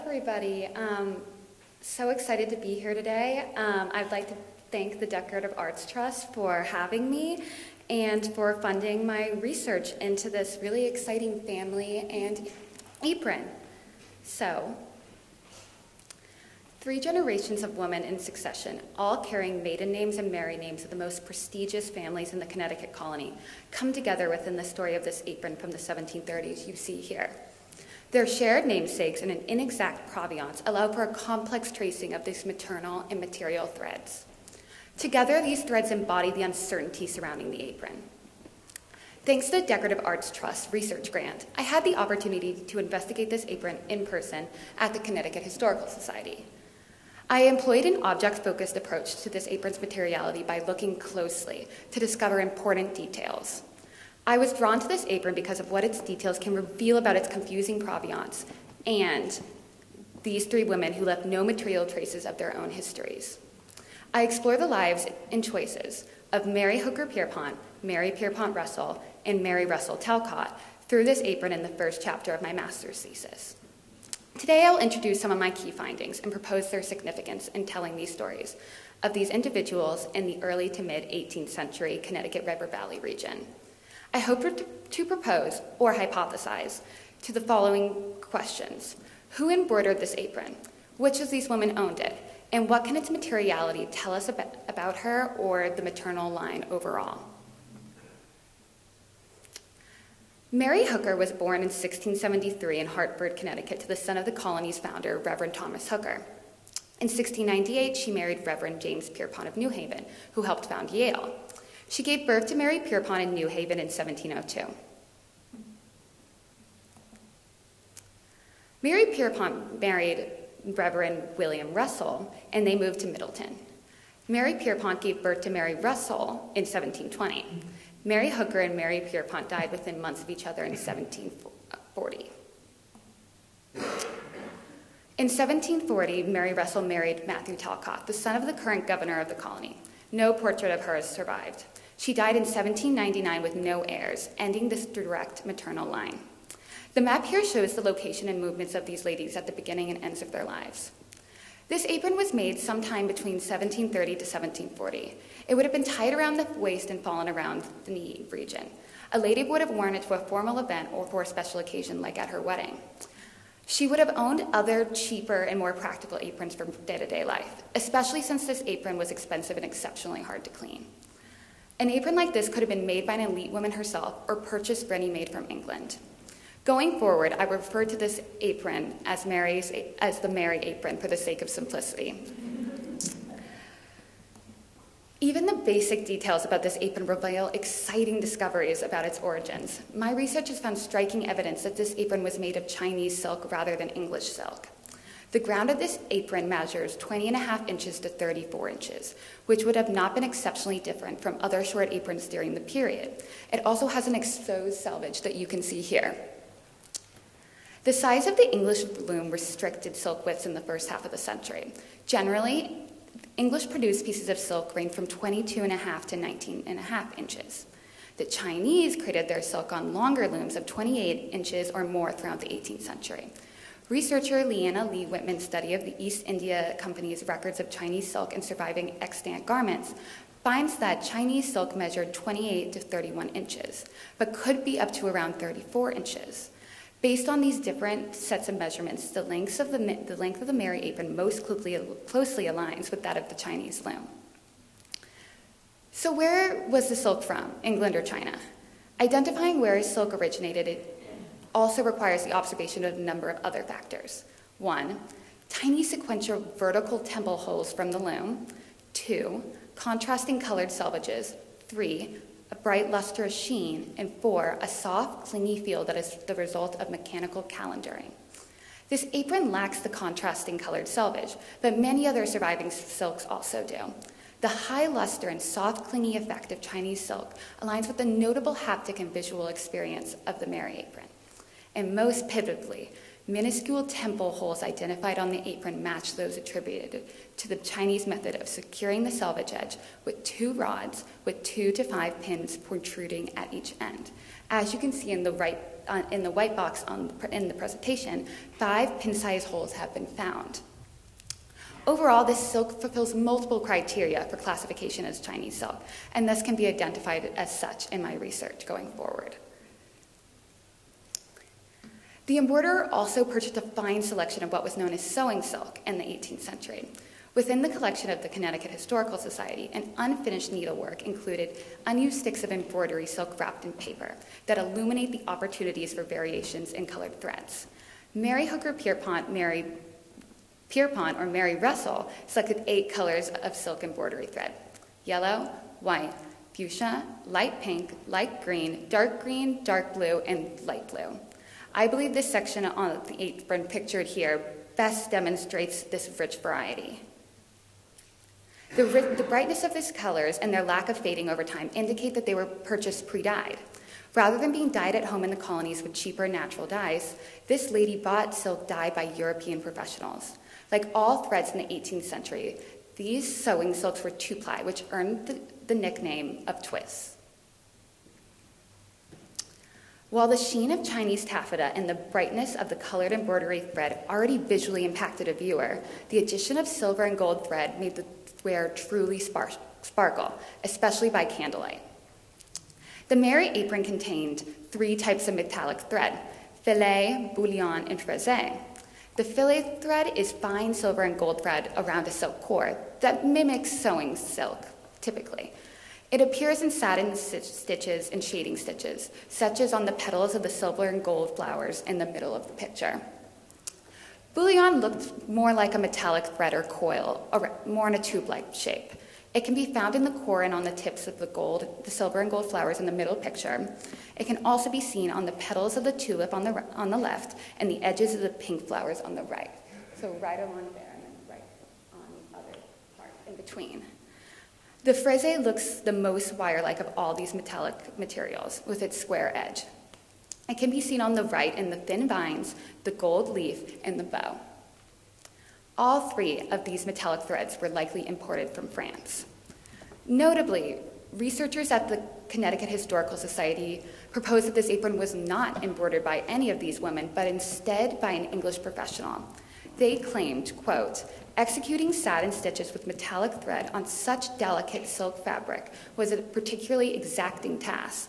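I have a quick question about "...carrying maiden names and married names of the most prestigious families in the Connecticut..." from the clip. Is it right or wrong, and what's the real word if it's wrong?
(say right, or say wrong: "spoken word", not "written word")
right.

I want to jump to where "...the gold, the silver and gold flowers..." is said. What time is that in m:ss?
6:51.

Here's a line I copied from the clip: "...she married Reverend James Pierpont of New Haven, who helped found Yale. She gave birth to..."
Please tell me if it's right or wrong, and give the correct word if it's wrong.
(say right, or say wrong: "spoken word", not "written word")
right.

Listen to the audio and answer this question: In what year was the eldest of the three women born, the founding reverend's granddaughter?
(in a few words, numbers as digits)
1673.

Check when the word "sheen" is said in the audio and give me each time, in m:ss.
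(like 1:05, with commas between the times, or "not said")
4:23, 6:10.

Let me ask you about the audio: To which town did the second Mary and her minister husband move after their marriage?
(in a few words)
Middletown.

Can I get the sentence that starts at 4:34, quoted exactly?
The high luster and soft, clingy effect of Chinese silk aligns with the notable haptic and visual experience of the Mary apron.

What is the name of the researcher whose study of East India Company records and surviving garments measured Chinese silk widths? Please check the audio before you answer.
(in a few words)
Leanna Lee Whitman.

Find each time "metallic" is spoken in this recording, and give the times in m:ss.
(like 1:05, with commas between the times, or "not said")
6:25, 6:45, 7:07, 7:16, 7:32.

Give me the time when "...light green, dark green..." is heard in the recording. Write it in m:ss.
5:38.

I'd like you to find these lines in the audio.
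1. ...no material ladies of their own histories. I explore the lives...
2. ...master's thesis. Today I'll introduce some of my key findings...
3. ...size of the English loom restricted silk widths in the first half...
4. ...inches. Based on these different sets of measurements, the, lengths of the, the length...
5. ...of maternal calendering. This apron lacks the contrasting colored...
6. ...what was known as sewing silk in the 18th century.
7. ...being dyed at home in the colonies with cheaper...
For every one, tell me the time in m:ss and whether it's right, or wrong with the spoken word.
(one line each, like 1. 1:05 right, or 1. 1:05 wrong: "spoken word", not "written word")
1. 1:01 wrong: "traces", not "ladies"
2. 1:12 right
3. 3:27 right
4. 3:55 right
5. 4:26 wrong: "mechanical", not "maternal"
6. 5:14 right
7. 5:54 right.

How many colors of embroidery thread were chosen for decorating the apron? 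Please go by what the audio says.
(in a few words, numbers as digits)
8.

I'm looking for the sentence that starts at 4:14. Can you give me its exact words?
One, tiny sequential vertical temple holes from the loom.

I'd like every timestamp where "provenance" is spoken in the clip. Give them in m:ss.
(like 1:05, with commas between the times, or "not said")
0:30, 0:57.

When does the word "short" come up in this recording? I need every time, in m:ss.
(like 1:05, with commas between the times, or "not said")
3:21.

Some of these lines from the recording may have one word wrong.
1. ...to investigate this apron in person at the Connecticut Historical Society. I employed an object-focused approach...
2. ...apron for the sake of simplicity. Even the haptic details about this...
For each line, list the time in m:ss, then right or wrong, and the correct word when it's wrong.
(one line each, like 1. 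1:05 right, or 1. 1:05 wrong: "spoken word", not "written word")
1. 0:42 right
2. 3:00 wrong: "basic", not "haptic".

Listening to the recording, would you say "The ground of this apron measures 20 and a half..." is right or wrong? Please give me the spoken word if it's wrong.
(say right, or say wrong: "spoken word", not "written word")
right.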